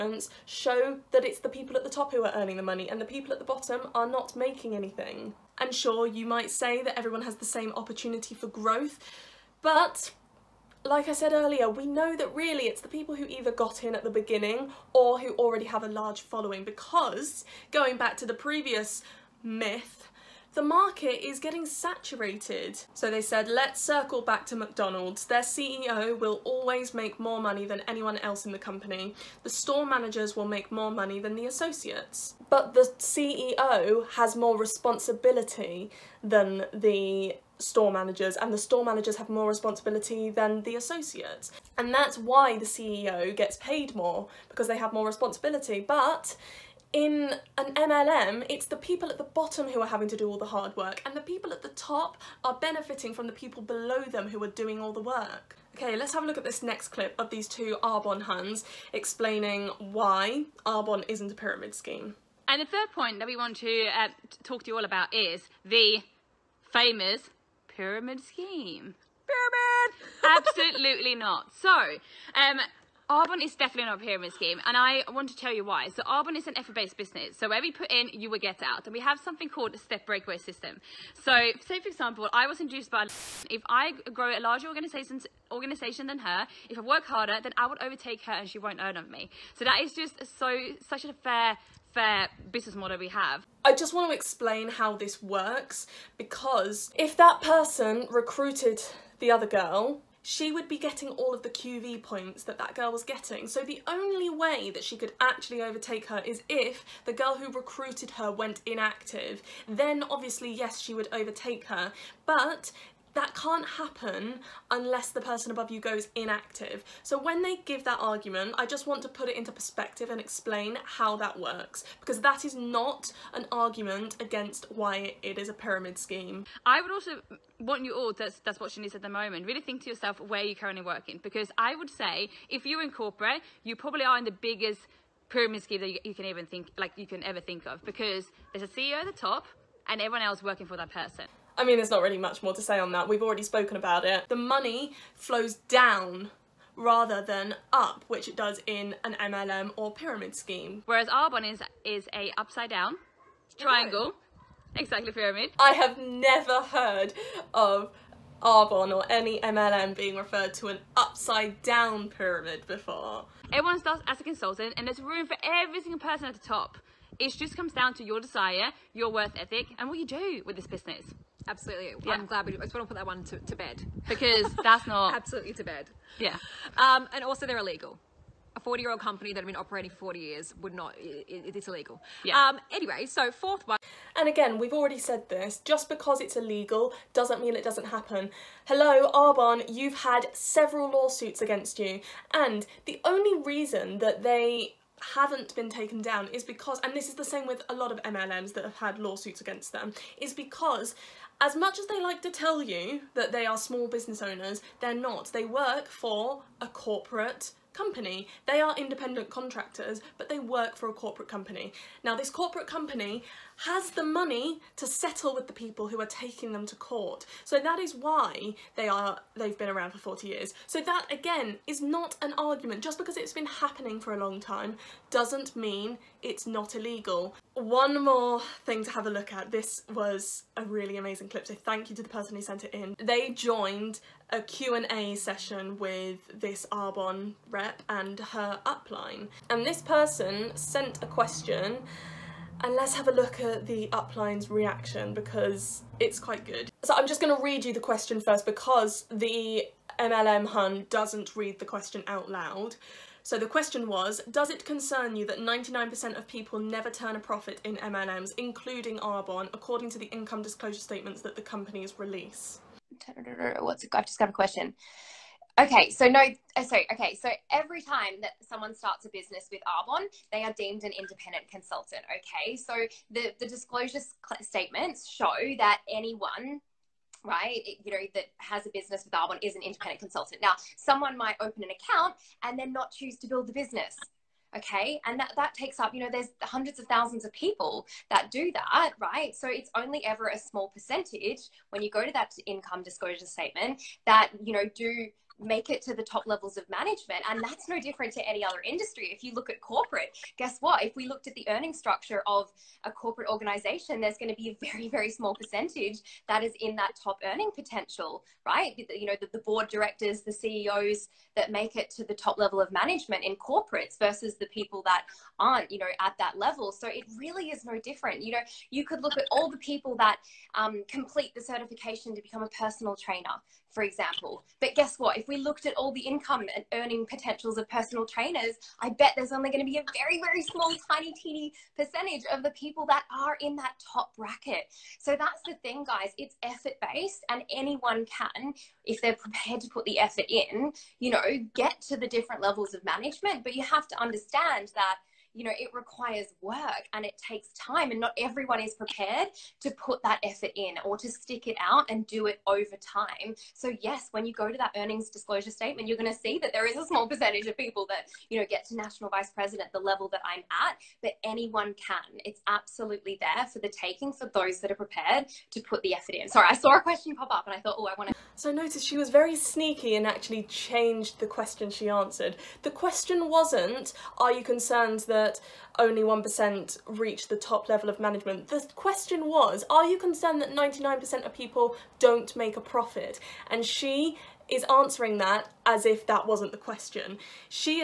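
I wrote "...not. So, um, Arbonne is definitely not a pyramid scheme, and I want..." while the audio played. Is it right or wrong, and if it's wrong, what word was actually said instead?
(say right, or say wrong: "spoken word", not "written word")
right.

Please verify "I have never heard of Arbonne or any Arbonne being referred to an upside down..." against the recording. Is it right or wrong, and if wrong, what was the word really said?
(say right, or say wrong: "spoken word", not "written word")
wrong: "MLM", not "Arbonne".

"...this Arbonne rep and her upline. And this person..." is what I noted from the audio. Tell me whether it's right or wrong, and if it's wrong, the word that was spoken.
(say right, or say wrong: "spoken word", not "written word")
right.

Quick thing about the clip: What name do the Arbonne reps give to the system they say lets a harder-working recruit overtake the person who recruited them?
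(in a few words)
step breakaway system.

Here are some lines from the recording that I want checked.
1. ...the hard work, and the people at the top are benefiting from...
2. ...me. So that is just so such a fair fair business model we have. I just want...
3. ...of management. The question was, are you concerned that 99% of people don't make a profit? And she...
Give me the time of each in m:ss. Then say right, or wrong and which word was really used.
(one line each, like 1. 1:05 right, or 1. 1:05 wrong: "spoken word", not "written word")
1. 0:50 right
2. 1:29 right
3. 6:17 right.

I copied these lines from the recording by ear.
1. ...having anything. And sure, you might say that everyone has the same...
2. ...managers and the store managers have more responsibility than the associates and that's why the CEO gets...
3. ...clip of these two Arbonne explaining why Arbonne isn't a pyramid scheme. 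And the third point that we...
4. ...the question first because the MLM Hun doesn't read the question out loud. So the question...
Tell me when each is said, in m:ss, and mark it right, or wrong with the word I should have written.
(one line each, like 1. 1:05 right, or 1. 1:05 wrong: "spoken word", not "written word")
1. 0:04 wrong: "making", not "having"
2. 0:37 right
3. 0:56 right
4. 4:07 right.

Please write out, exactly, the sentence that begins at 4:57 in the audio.
And that's no different to any other industry.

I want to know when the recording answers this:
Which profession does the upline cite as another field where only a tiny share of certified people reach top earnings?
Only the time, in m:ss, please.
5:22.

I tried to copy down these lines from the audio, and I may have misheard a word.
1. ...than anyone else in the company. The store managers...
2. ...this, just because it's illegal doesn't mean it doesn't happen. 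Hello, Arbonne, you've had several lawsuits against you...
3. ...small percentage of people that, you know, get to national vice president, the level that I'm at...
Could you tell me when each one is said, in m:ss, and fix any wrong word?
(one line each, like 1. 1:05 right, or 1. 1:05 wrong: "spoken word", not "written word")
1. 0:27 right
2. 3:05 right
3. 5:56 right.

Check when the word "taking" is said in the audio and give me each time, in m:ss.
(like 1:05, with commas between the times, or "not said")
3:36, 6:03.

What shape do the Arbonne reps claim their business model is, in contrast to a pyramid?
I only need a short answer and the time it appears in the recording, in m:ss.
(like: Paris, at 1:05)
upside down triangle, at 2:32.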